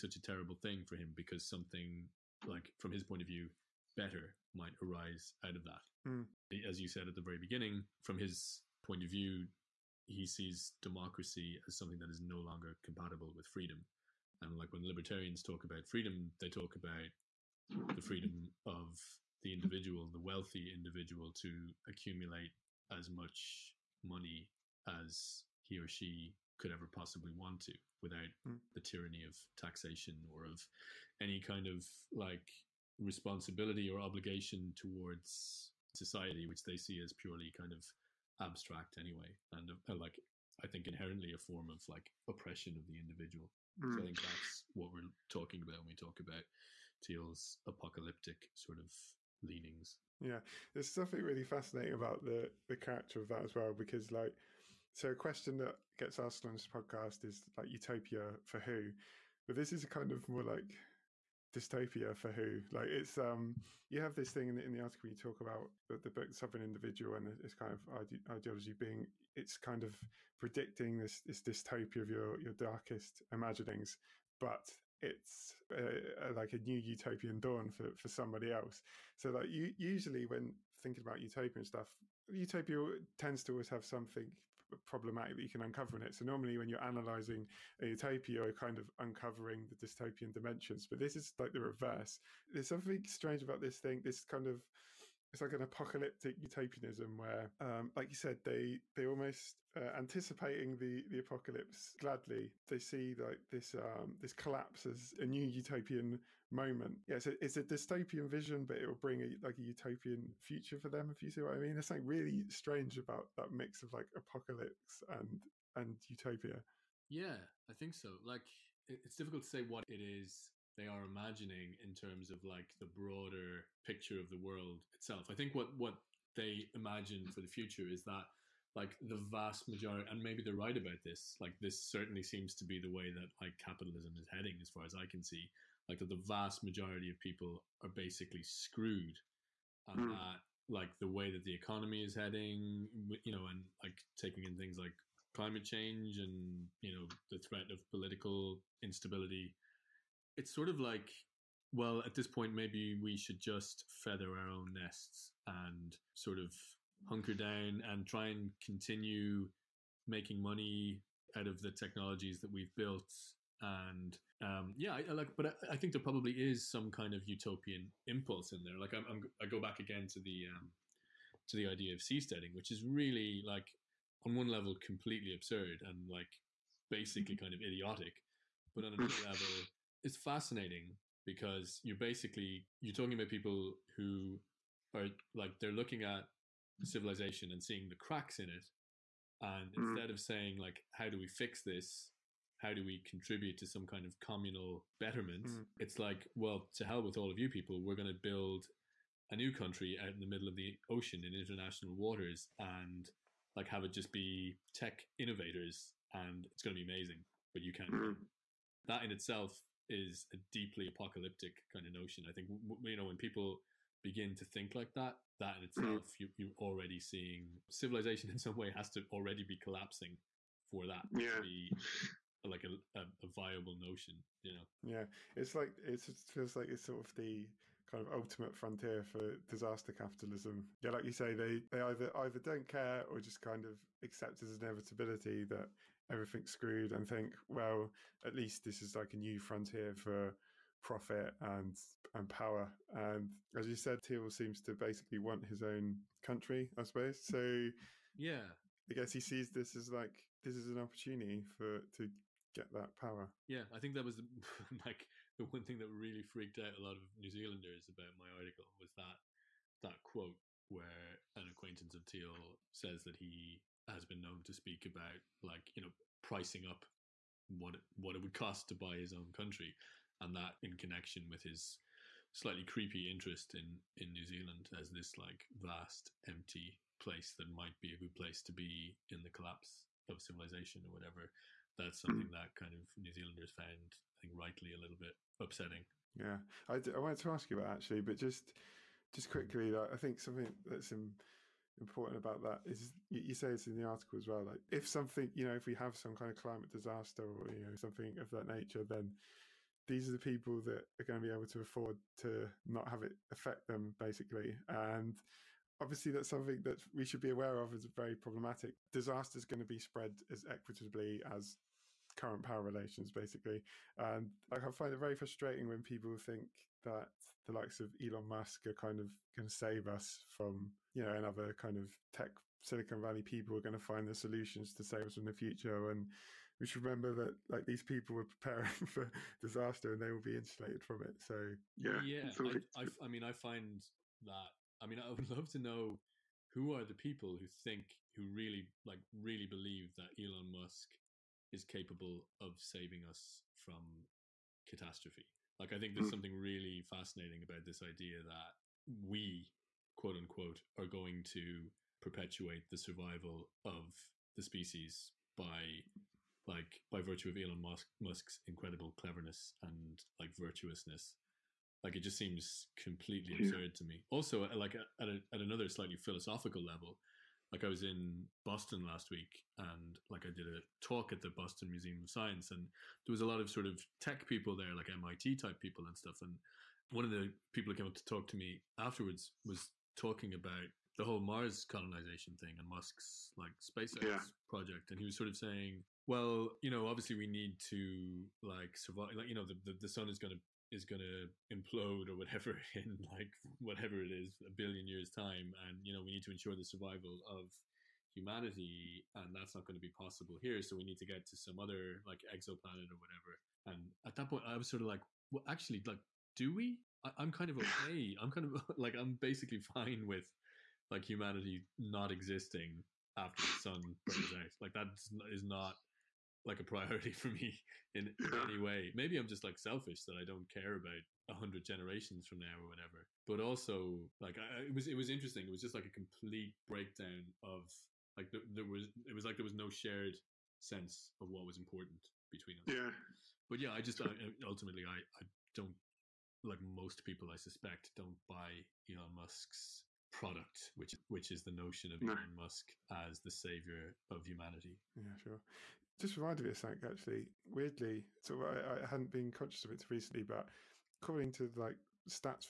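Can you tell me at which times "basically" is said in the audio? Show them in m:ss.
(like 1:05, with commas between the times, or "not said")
2:17, 2:56, 3:01, 4:04, 5:03, 5:13, 6:49.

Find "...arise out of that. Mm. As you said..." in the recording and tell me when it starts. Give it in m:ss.
0:04.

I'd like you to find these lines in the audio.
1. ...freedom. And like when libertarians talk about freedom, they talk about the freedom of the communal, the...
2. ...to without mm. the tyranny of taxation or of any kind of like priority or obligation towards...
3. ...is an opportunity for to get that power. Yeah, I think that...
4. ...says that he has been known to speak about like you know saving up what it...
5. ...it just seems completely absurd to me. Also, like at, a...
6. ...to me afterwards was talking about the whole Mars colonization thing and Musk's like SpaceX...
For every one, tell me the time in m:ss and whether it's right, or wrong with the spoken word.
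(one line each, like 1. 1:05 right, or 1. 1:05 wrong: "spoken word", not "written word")
1. 0:13 wrong: "individual", not "communal"
2. 0:27 wrong: "responsibility", not "priority"
3. 4:10 right
4. 4:22 wrong: "pricing", not "saving"
5. 6:01 right
6. 6:18 right.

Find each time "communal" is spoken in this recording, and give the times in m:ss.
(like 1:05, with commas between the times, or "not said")
3:14.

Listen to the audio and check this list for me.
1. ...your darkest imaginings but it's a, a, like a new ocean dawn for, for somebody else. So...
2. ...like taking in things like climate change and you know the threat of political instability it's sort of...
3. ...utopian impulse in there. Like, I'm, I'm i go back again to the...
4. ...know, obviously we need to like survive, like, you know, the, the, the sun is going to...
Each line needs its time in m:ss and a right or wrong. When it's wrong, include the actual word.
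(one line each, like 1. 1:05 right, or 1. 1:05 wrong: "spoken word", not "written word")
1. 1:12 wrong: "utopian", not "ocean"
2. 2:23 right
3. 2:47 right
4. 6:26 right.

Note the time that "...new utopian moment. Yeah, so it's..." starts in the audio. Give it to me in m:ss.
1:45.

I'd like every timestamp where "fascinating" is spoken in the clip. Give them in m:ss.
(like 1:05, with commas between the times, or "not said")
0:51, 3:00, 5:46.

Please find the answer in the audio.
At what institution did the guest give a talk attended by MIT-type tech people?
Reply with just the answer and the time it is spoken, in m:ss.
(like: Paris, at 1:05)
Boston Museum of Science, at 6:11.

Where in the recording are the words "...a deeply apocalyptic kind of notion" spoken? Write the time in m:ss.
3:30.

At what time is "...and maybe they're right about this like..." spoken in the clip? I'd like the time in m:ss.
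2:10.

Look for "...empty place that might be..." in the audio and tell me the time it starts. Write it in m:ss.
4:36.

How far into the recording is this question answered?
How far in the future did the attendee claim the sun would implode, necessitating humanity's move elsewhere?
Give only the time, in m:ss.
6:34.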